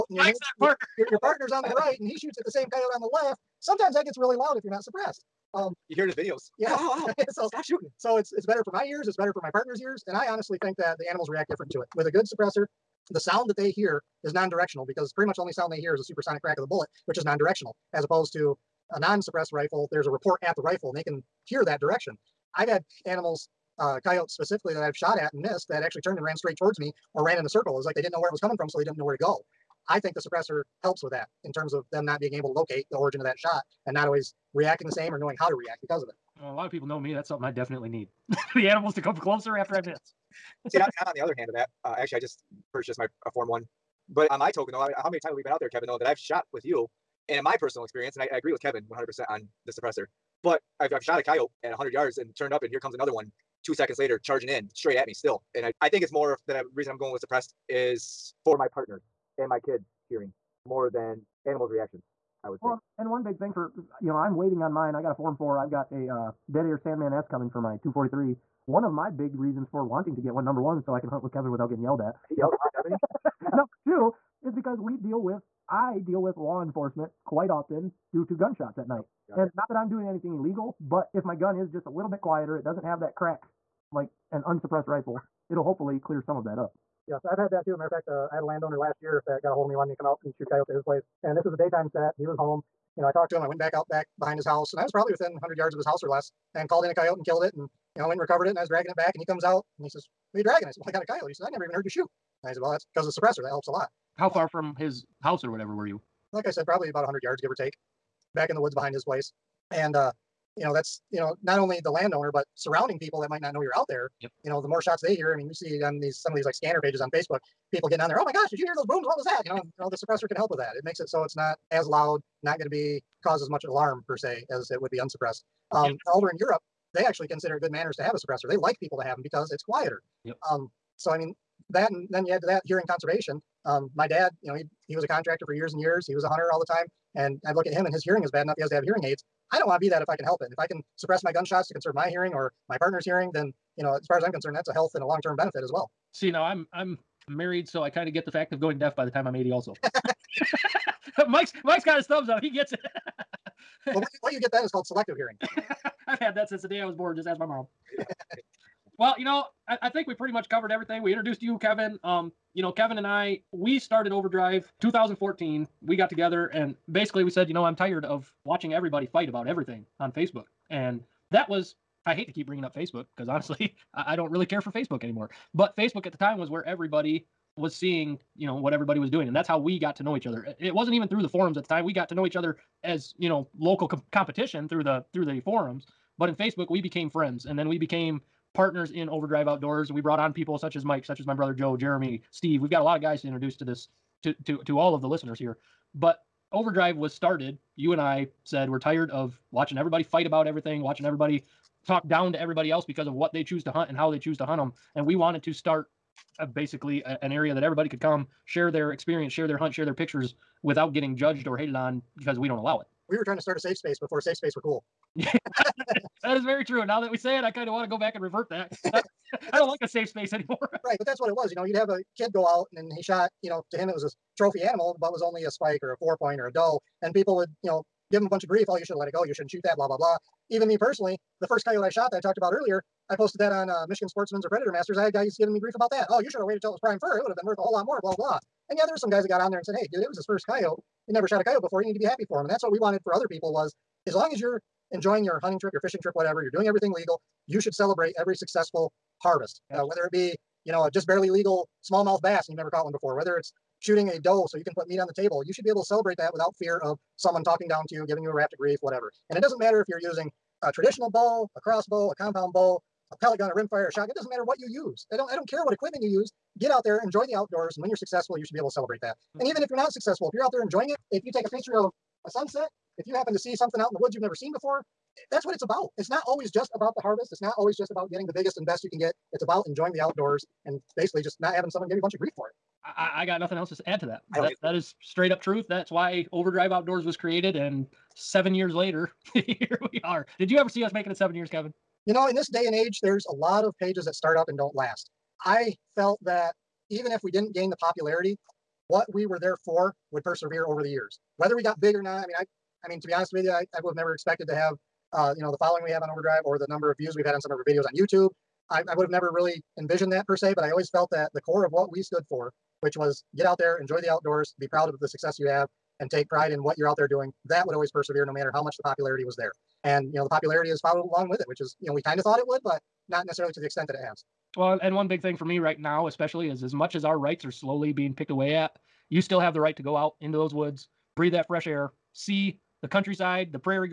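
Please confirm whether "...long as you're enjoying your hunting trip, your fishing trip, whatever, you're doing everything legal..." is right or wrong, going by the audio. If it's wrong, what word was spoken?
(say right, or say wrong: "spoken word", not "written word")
right.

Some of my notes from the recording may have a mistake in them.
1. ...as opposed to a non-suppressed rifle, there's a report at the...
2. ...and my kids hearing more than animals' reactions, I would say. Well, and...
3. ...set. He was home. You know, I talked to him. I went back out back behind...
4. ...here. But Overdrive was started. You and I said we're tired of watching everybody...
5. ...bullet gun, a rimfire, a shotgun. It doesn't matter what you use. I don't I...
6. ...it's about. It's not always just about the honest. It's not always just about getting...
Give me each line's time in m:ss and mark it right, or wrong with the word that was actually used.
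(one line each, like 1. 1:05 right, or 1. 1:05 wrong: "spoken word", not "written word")
1. 0:17 right
2. 0:59 right
3. 1:31 right
4. 3:15 right
5. 4:23 wrong: "pellet", not "bullet"
6. 4:35 wrong: "harvest", not "honest".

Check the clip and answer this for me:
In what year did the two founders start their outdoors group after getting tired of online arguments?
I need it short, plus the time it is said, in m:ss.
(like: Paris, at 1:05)
2014, at 2:44.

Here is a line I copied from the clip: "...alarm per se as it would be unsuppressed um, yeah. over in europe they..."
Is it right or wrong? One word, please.
right.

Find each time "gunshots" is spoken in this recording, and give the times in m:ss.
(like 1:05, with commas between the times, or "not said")
1:18, 2:21.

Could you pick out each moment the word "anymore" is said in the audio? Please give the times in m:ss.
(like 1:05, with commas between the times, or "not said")
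2:55, 3:40.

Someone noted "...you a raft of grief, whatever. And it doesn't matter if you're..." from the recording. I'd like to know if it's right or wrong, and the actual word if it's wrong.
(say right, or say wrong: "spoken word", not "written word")
right.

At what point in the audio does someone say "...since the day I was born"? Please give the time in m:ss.
2:36.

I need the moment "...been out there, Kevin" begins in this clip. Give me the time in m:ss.
0:45.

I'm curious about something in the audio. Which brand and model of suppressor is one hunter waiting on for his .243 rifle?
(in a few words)
Dead Air Sandman S.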